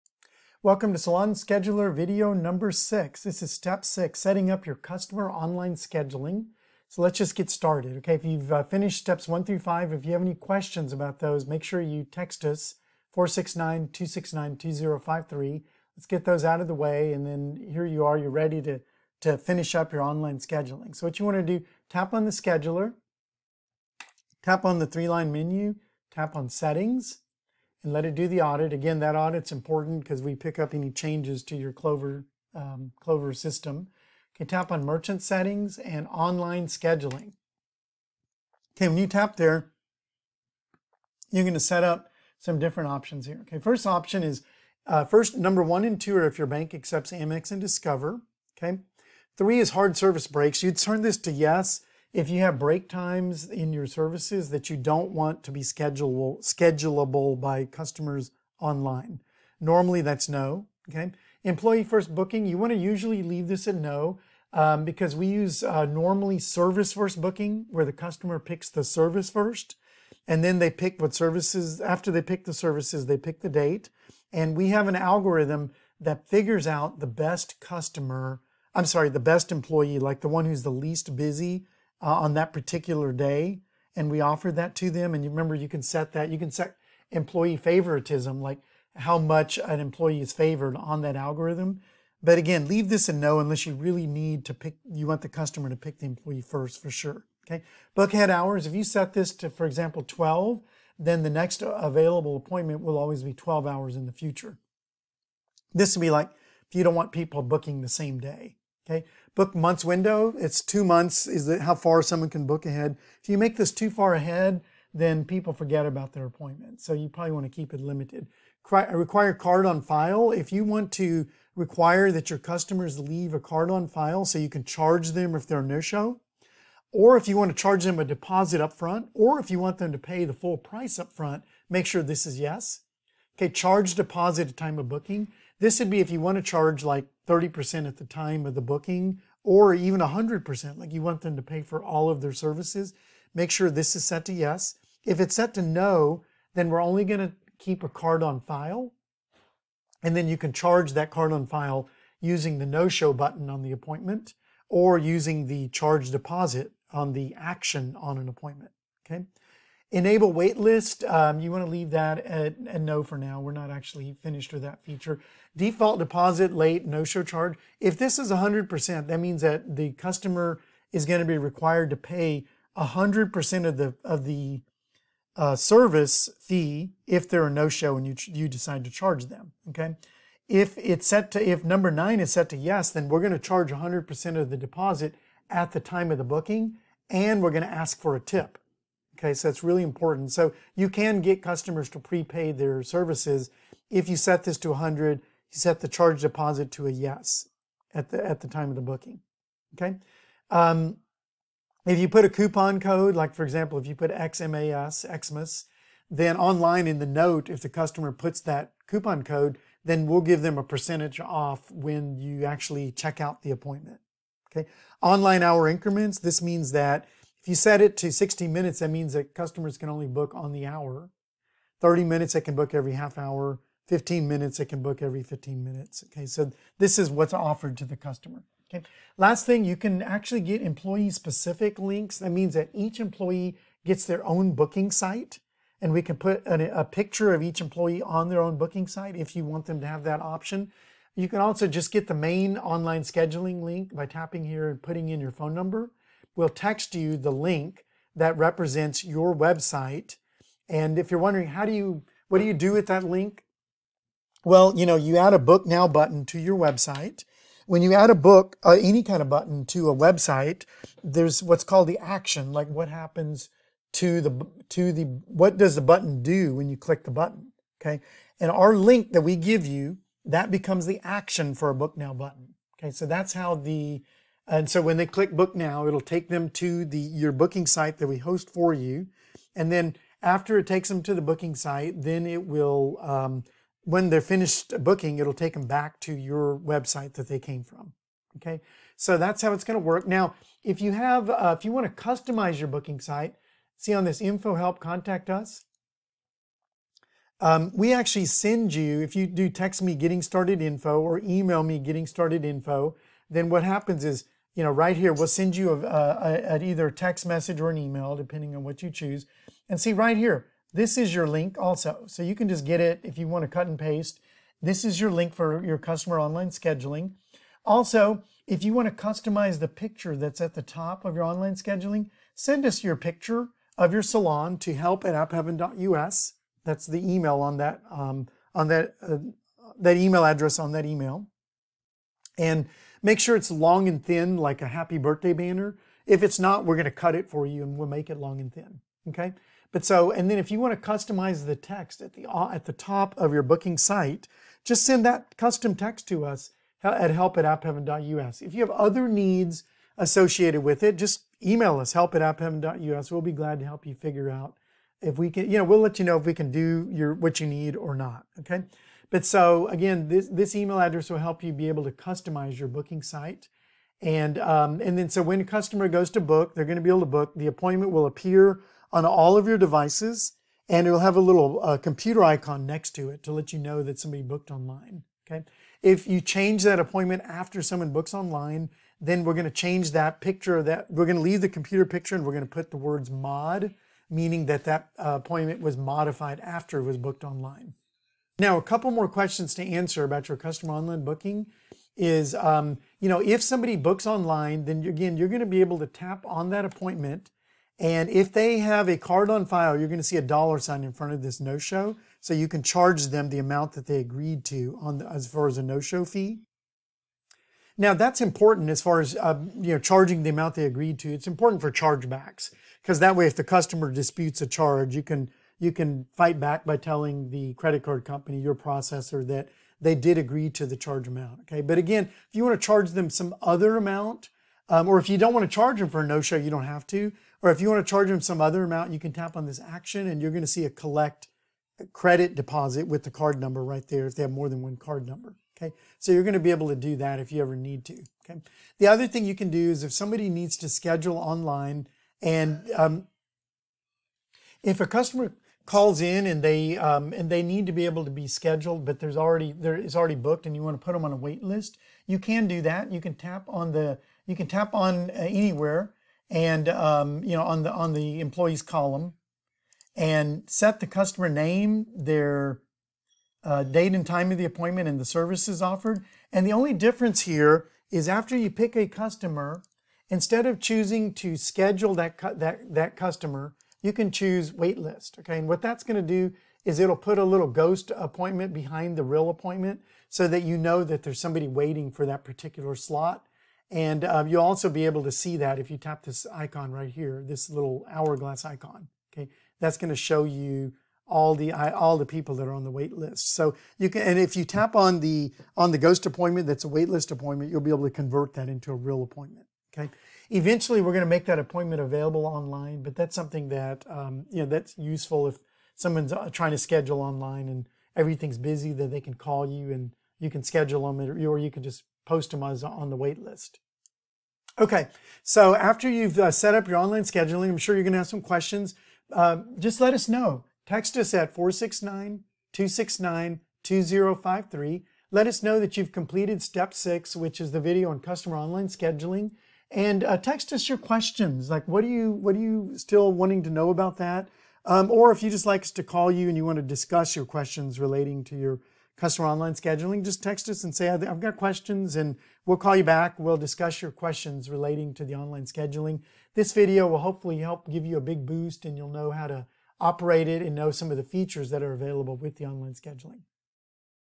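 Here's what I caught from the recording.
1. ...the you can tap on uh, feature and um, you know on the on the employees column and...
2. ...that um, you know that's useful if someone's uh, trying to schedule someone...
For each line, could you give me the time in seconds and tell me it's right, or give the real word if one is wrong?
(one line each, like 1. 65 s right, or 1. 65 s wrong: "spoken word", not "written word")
1. 453 s wrong: "anywhere", not "feature"
2. 503 s wrong: "online", not "someone".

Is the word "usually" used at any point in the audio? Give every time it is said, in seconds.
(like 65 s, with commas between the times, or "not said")
62 s.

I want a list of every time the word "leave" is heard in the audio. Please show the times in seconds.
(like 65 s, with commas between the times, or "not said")
63 s, 92 s, 122 s, 161 s, 381 s.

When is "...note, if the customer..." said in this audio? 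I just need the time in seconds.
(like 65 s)
207 s.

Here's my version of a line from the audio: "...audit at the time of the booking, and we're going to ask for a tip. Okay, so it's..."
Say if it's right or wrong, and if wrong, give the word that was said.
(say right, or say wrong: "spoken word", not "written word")
wrong: "deposit", not "audit".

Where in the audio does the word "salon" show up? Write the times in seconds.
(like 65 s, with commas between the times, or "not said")
0 s, 324 s.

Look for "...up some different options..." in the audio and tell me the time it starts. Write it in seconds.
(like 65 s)
41 s.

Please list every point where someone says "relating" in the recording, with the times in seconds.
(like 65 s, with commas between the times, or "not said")
537 s, 544 s.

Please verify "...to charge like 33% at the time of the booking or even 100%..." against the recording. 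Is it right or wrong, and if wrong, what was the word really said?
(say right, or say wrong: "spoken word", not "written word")
wrong: "30", not "33".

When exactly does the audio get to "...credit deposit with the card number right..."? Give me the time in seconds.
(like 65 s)
431 s.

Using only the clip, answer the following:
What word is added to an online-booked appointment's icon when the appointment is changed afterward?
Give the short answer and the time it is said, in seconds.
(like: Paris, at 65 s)
mod, at 383 s.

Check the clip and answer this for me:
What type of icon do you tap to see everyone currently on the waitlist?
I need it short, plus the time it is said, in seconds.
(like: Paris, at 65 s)
hourglass, at 487 s.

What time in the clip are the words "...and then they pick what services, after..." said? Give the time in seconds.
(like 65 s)
70 s.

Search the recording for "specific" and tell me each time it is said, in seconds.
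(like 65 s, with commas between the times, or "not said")
231 s.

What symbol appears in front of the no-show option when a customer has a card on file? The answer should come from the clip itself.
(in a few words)
dollar sign.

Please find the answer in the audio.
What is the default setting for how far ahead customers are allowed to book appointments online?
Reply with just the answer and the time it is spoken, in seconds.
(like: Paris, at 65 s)
2 months, at 110 s.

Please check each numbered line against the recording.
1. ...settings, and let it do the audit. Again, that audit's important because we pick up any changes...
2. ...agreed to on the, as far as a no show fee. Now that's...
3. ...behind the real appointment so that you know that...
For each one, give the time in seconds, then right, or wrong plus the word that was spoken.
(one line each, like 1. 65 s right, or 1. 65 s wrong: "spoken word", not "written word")
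1. 26 s right
2. 403 s right
3. 478 s right.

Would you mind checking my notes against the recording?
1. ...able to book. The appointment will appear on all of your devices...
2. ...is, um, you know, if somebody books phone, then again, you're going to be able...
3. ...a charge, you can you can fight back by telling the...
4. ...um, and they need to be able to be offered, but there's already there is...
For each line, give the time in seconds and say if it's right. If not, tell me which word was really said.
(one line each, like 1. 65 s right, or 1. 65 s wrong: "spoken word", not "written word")
1. 366 s right
2. 391 s wrong: "online", not "phone"
3. 414 s right
4. 446 s wrong: "scheduled", not "offered".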